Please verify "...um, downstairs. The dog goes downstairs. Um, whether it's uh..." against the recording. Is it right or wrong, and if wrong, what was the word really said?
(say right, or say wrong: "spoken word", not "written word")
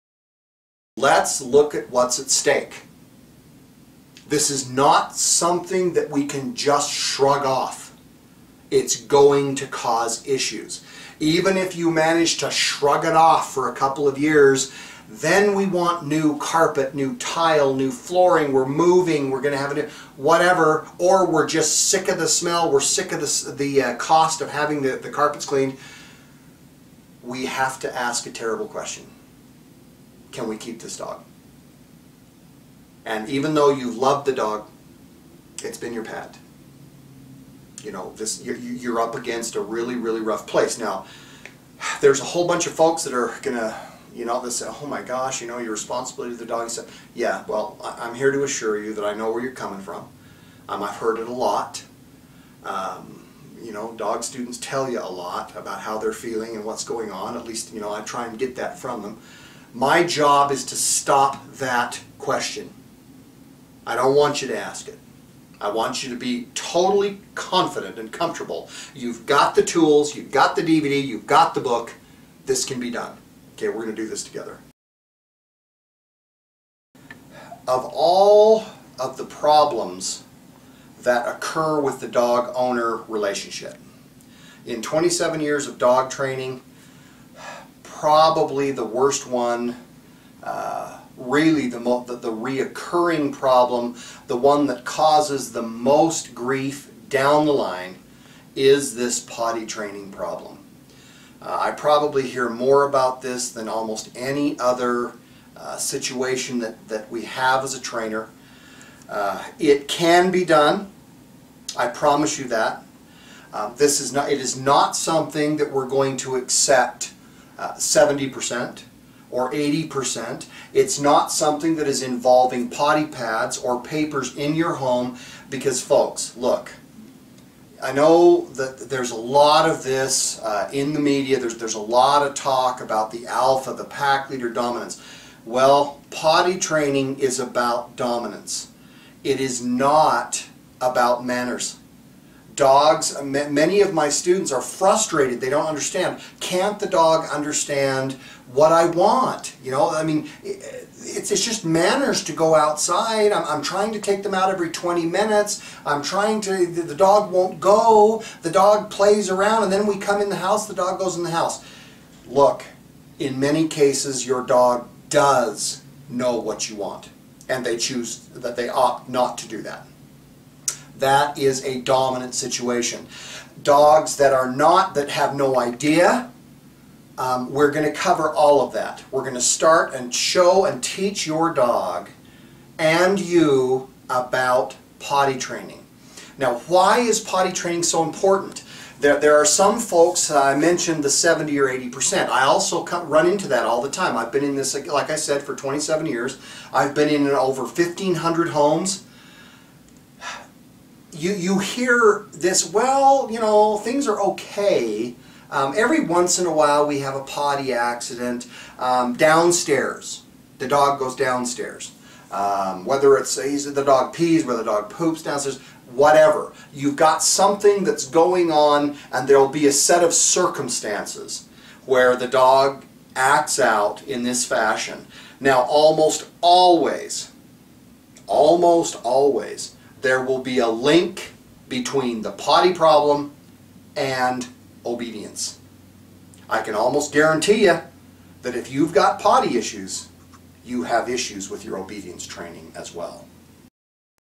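right.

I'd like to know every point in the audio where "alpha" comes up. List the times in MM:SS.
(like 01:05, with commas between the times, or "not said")
02:13.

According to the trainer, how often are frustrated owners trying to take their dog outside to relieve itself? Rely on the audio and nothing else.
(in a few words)
every 20 minutes.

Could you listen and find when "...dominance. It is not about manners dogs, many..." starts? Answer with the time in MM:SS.
02:17.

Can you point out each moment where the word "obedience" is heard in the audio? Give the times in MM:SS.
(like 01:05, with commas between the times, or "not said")
03:54, 04:01.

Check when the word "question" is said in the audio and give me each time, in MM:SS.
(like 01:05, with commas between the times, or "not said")
00:28, 01:02.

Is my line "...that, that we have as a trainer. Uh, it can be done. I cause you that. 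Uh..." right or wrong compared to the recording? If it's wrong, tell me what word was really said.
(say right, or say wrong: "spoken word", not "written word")
wrong: "promise", not "cause".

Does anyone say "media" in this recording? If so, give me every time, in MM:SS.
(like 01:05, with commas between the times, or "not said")
02:10.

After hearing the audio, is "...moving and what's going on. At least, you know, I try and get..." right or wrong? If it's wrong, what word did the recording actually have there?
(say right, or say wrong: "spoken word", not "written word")
wrong: "feeling", not "moving".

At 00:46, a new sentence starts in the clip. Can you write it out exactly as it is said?
said, yeah, well, I'm here to assure you that I know where you're coming from.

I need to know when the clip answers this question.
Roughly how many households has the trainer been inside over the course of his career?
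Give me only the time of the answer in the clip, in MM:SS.
03:17.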